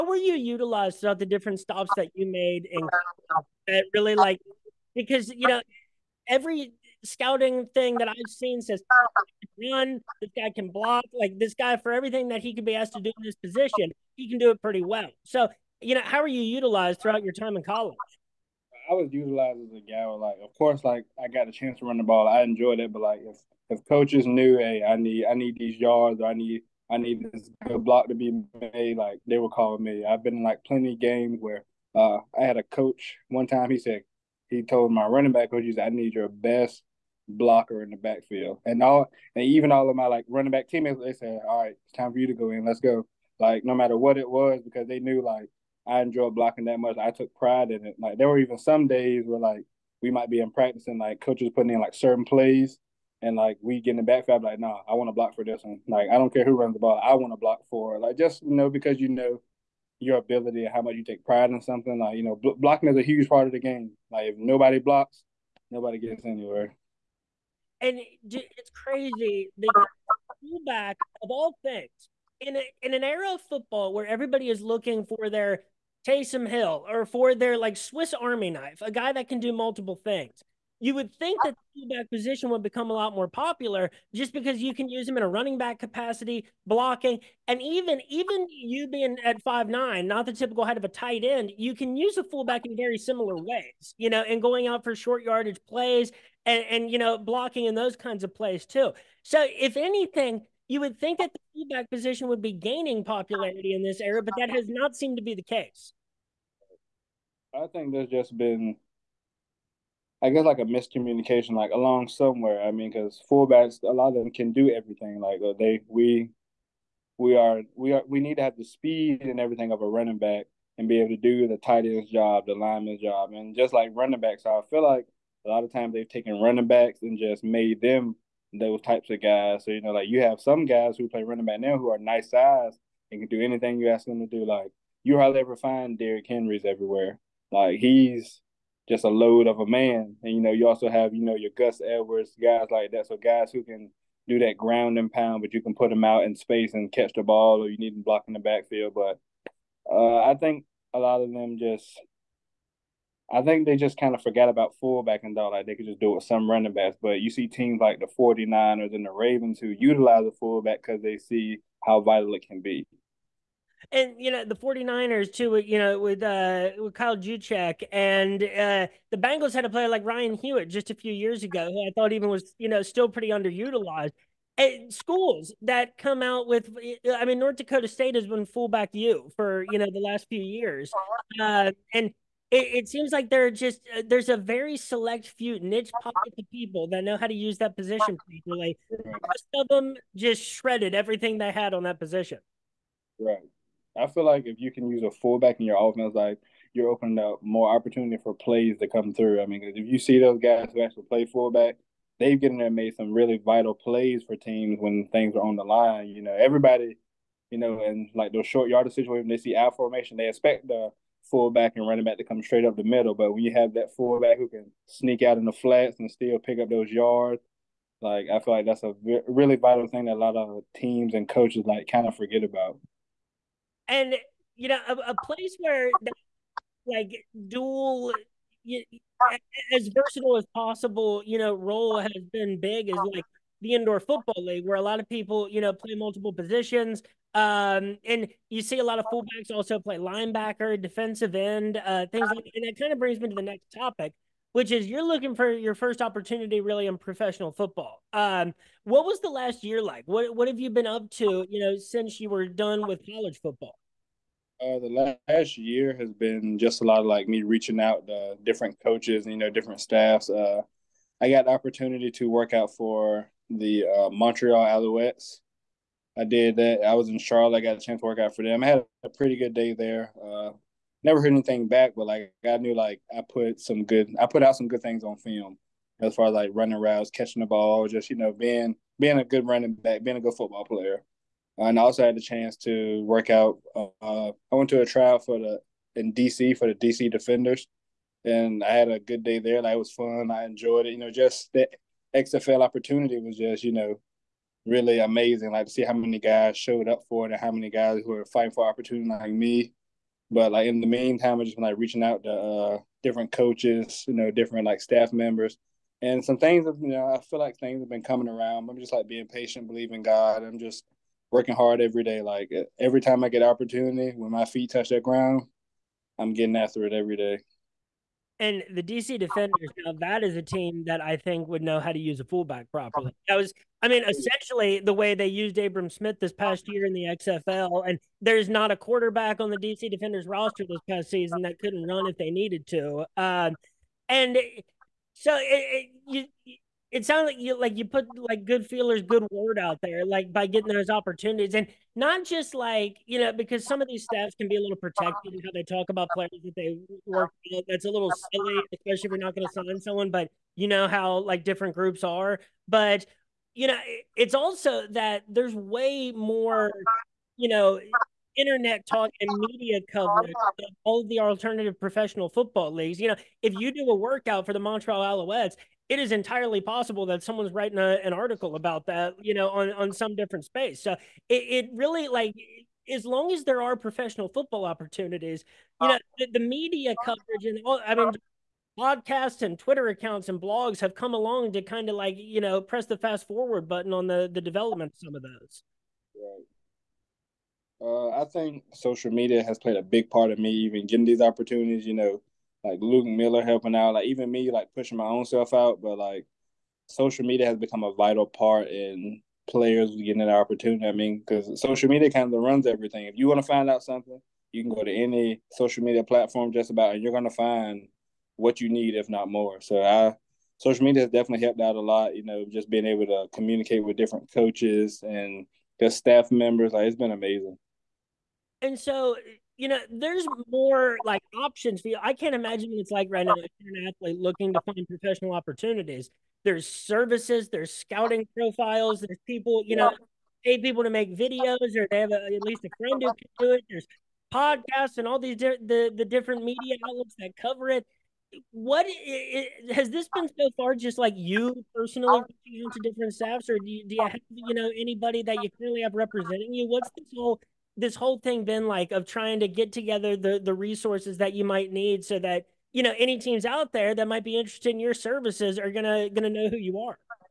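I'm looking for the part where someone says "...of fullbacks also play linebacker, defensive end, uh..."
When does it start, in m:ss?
3:58.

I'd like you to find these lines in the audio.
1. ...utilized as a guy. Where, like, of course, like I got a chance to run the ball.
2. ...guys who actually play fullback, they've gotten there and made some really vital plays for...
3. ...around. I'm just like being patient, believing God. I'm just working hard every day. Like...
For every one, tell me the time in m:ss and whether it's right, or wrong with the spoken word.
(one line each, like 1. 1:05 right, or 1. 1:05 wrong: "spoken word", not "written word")
1. 0:19 right
2. 3:20 right
3. 5:08 right.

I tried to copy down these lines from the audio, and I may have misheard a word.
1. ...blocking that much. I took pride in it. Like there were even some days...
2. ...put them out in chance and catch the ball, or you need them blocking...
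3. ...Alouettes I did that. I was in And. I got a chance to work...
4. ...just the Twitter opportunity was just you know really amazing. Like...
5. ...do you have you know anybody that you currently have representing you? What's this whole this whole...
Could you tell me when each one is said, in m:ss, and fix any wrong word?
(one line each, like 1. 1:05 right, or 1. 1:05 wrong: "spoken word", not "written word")
1. 0:46 right
2. 2:25 wrong: "space", not "chance"
3. 4:24 wrong: "Charlotte", not "And"
4. 4:51 wrong: "XFL", not "Twitter"
5. 7:23 right.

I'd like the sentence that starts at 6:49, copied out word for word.
So I social media has definitely helped out a lot.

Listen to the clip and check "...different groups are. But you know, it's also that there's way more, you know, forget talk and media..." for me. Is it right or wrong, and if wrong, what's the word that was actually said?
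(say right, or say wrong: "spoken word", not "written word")
wrong: "internet", not "forget".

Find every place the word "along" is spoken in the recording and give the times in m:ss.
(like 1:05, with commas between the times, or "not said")
1:51, 6:21.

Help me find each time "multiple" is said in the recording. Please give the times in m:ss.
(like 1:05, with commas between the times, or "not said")
1:19, 3:55.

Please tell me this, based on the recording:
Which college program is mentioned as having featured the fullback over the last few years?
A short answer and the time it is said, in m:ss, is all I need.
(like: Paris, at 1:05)
North Dakota State, at 2:57.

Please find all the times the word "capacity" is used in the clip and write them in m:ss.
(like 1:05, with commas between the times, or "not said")
1:25.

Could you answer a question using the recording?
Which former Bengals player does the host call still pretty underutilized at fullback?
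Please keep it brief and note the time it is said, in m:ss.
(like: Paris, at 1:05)
Ryan Hewitt, at 2:50.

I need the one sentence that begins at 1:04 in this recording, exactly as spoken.
Like if nobody blocks, nobody gets anywhere.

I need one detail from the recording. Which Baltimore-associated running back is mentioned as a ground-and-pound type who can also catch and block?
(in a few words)
Gus Edwards.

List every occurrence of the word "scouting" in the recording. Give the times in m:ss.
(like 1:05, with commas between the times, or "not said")
0:07, 7:07.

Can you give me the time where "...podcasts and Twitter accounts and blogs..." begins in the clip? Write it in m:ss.
6:18.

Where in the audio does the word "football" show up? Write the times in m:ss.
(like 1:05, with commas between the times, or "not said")
1:13, 3:53, 4:07, 4:13, 4:40, 6:02, 6:14.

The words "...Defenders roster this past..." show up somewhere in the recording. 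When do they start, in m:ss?
5:29.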